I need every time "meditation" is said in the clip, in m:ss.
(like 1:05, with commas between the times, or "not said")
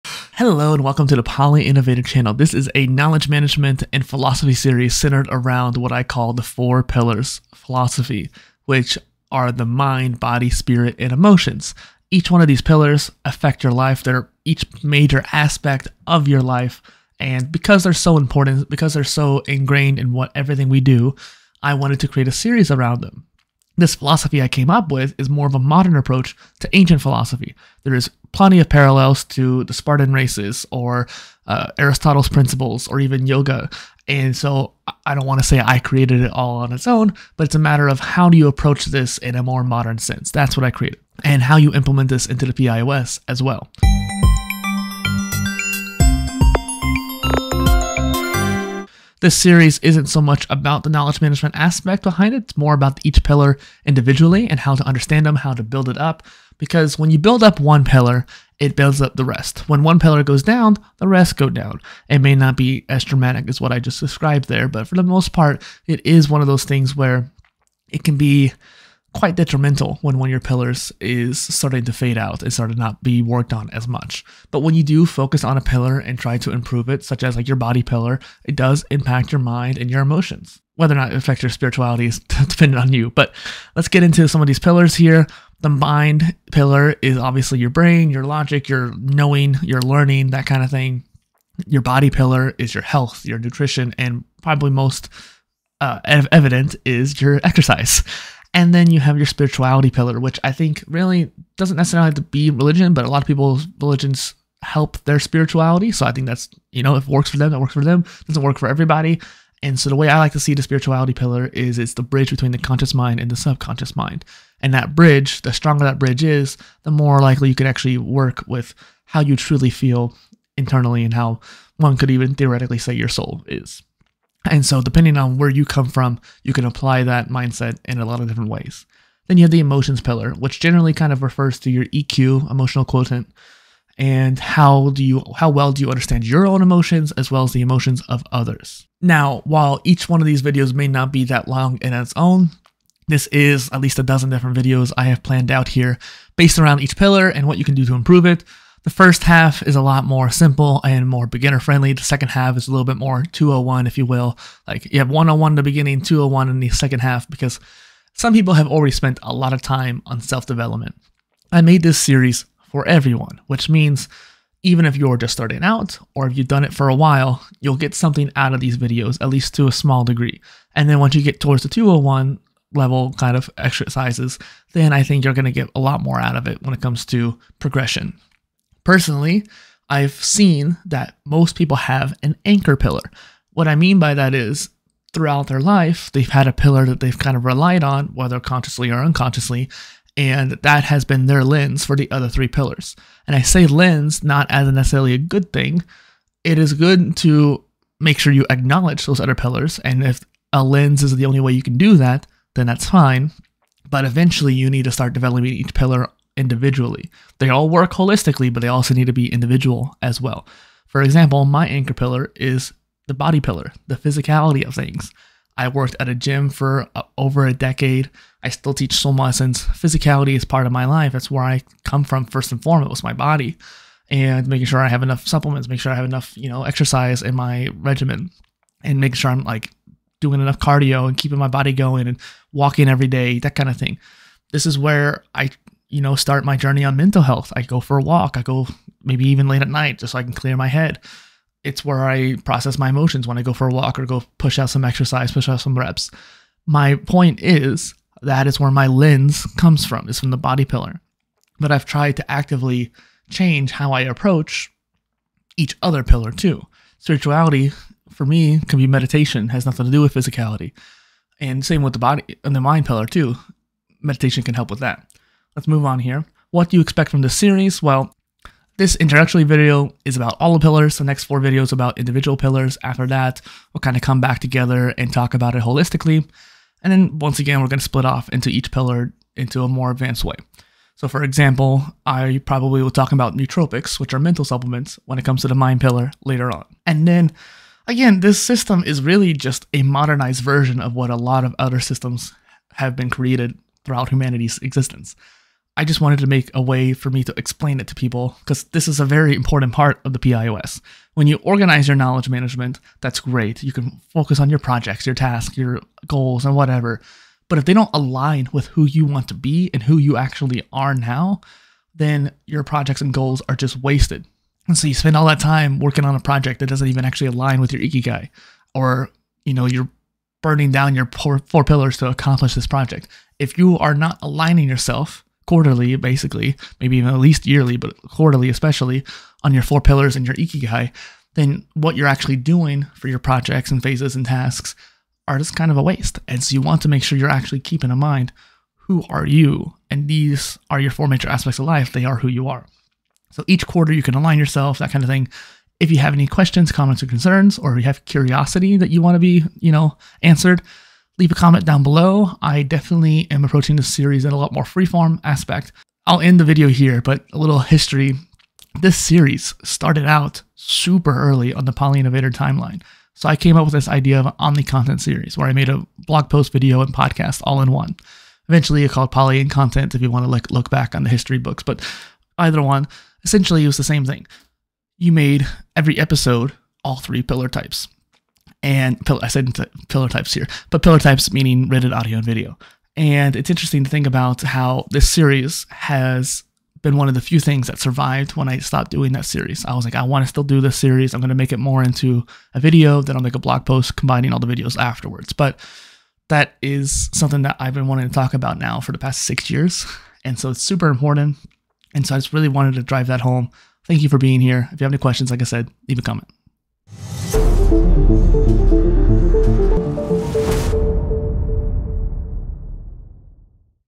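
4:18, 4:24.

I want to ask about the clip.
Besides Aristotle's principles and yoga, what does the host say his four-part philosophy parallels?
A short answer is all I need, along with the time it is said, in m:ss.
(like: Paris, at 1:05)
Spartan races, at 0:29.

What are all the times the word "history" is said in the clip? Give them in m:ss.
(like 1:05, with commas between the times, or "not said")
5:57, 6:11.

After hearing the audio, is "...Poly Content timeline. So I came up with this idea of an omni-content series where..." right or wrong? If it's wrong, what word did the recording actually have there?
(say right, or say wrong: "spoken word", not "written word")
wrong: "Innovator", not "Content".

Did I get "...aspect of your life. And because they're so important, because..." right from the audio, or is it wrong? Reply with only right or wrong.
right.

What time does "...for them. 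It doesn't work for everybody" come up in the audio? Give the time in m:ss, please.
1:47.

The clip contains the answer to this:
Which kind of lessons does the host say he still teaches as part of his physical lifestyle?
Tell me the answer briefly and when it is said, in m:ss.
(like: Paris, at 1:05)
Swim lessons, at 3:38.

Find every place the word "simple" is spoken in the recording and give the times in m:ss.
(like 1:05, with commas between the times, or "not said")
2:30.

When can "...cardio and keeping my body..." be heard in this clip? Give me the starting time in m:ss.
3:50.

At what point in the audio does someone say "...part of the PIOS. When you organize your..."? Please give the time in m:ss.
4:59.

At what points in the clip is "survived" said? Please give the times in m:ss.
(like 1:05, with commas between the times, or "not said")
6:27.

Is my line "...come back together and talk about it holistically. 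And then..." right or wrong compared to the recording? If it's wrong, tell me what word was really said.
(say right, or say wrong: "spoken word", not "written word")
right.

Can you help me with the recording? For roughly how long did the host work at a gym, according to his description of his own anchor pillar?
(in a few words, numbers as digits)
Over a decade.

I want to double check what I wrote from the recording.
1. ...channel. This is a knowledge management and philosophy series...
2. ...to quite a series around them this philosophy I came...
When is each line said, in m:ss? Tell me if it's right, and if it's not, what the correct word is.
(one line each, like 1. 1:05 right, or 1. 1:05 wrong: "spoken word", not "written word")
1. 0:02 right
2. 0:21 wrong: "create", not "quite".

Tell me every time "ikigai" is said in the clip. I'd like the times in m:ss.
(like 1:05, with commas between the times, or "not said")
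5:17, 5:30.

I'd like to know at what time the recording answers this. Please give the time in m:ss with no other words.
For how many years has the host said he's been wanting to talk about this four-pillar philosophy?
6:39.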